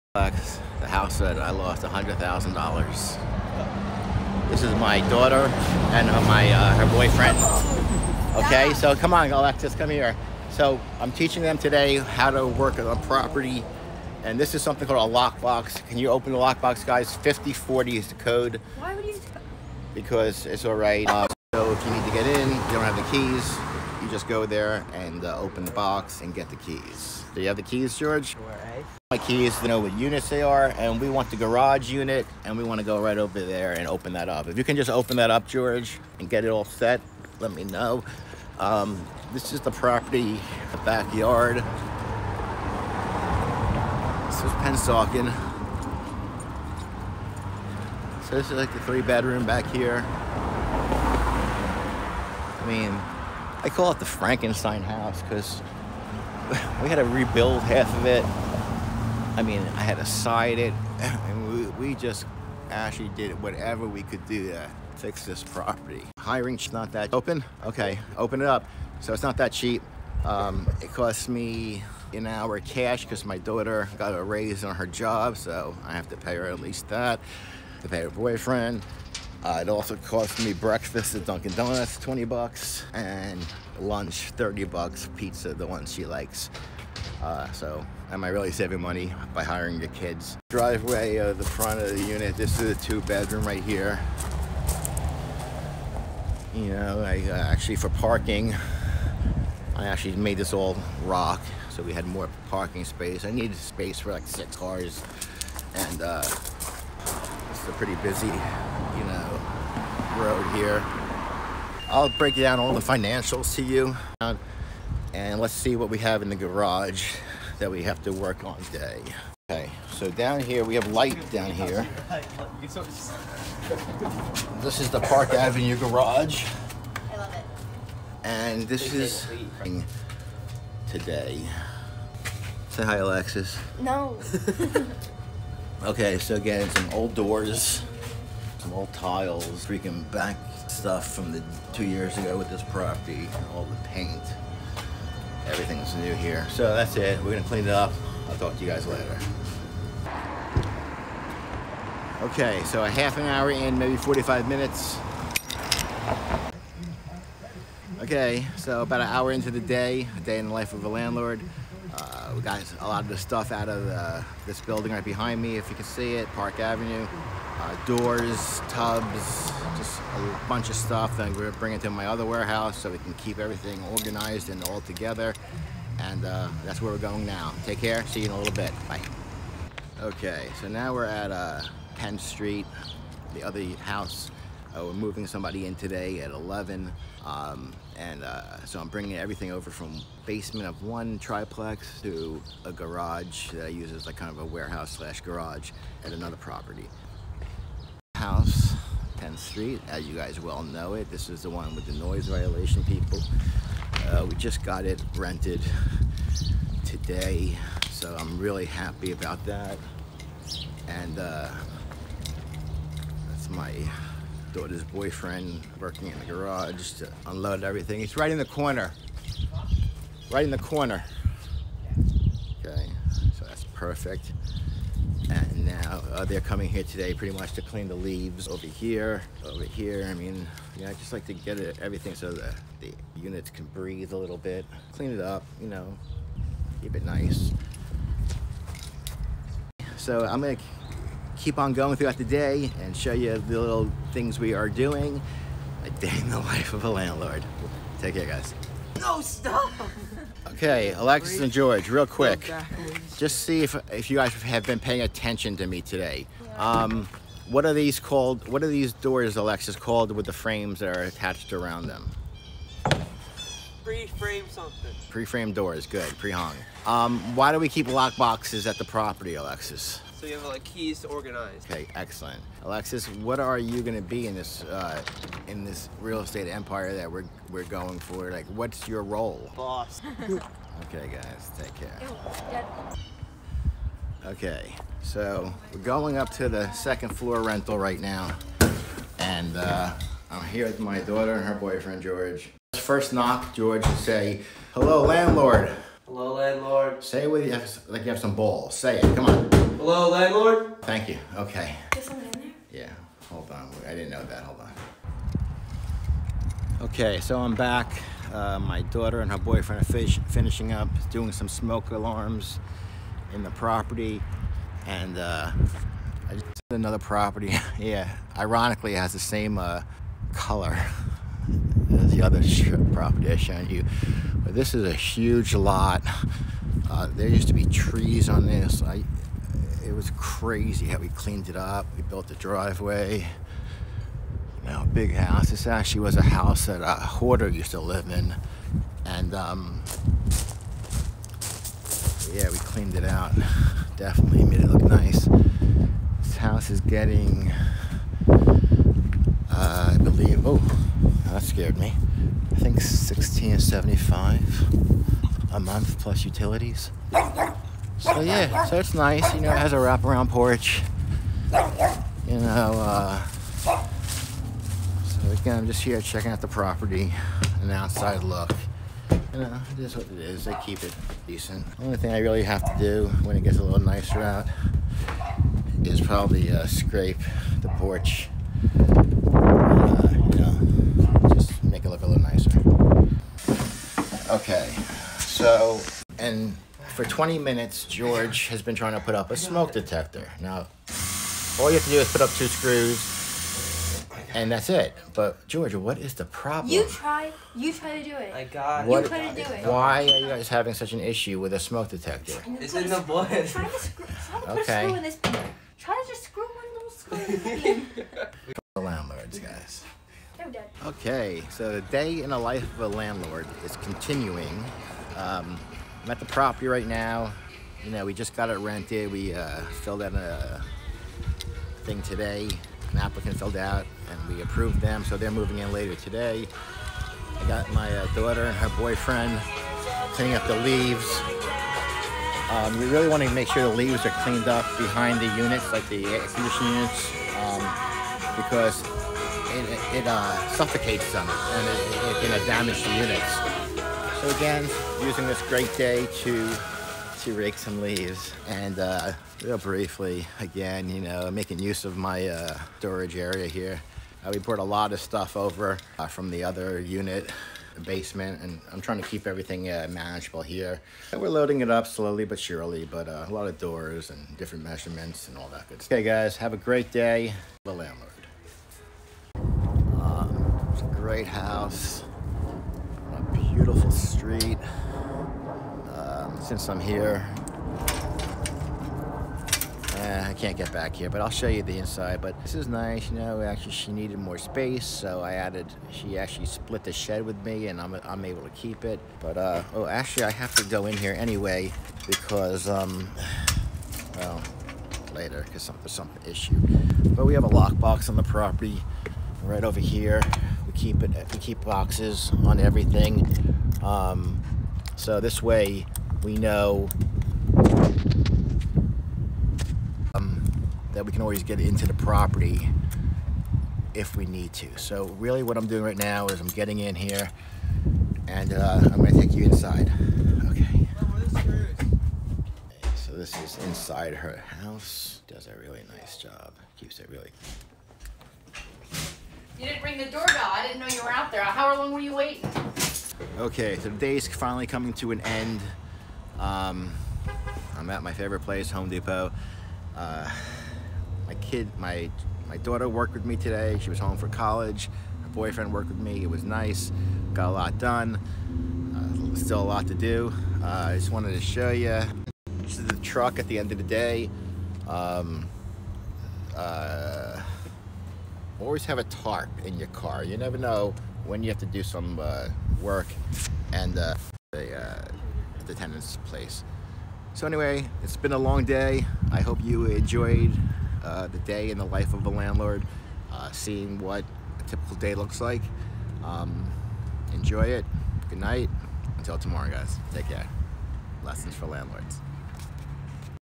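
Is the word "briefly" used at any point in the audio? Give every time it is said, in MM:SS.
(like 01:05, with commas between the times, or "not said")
07:29.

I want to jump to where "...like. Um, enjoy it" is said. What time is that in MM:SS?
09:35.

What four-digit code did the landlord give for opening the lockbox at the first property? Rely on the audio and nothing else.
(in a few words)
5040.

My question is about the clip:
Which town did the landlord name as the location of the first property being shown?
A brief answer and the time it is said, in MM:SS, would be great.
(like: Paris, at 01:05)
Pennsauken, at 00:44.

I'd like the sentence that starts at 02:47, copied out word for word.
Uh, doors, tubs, just a bunch of stuff.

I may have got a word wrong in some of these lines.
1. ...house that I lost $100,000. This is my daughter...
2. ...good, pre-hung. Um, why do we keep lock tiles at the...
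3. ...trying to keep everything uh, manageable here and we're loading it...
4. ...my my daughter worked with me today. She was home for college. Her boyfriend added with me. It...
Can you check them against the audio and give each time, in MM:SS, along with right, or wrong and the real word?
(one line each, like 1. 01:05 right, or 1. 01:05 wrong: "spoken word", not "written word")
1. 00:00 right
2. 04:25 wrong: "boxes", not "tiles"
3. 07:38 right
4. 09:01 wrong: "worked", not "added".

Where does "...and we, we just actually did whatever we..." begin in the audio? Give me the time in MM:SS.
01:00.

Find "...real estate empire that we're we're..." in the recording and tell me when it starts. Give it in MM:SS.
04:35.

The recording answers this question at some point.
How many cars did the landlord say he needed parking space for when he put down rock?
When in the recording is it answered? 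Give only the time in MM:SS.
01:44.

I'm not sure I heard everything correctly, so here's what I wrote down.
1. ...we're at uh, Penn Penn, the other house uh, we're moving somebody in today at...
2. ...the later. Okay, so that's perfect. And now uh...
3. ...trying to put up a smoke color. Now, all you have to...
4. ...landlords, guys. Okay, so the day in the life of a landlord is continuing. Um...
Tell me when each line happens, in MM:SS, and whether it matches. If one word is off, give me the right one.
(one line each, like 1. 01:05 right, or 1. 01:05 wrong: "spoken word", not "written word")
1. 03:00 wrong: "Street", not "Penn"
2. 03:40 wrong: "corner", not "later"
3. 06:28 wrong: "detector", not "color"
4. 06:48 right.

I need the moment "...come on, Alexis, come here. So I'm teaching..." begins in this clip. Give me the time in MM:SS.
00:08.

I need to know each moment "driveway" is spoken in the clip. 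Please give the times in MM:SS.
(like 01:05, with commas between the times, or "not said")
01:30, 05:32.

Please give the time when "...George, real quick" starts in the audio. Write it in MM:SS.
04:11.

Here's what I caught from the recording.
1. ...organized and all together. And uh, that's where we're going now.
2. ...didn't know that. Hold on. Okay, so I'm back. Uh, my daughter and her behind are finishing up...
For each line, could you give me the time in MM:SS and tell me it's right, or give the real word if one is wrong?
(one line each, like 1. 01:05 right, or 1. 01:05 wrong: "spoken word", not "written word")
1. 02:53 right
2. 05:03 wrong: "boyfriend", not "behind".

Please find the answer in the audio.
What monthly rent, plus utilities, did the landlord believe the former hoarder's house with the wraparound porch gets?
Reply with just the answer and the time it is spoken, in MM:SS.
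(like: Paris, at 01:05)
$1,675, at 05:52.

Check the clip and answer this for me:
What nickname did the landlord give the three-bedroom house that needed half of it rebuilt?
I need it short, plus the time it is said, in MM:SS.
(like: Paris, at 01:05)
Frankenstein house, at 00:54.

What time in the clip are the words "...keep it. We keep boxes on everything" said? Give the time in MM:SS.
08:20.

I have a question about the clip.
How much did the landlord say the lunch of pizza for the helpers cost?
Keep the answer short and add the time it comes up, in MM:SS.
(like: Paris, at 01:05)
$30, at 01:24.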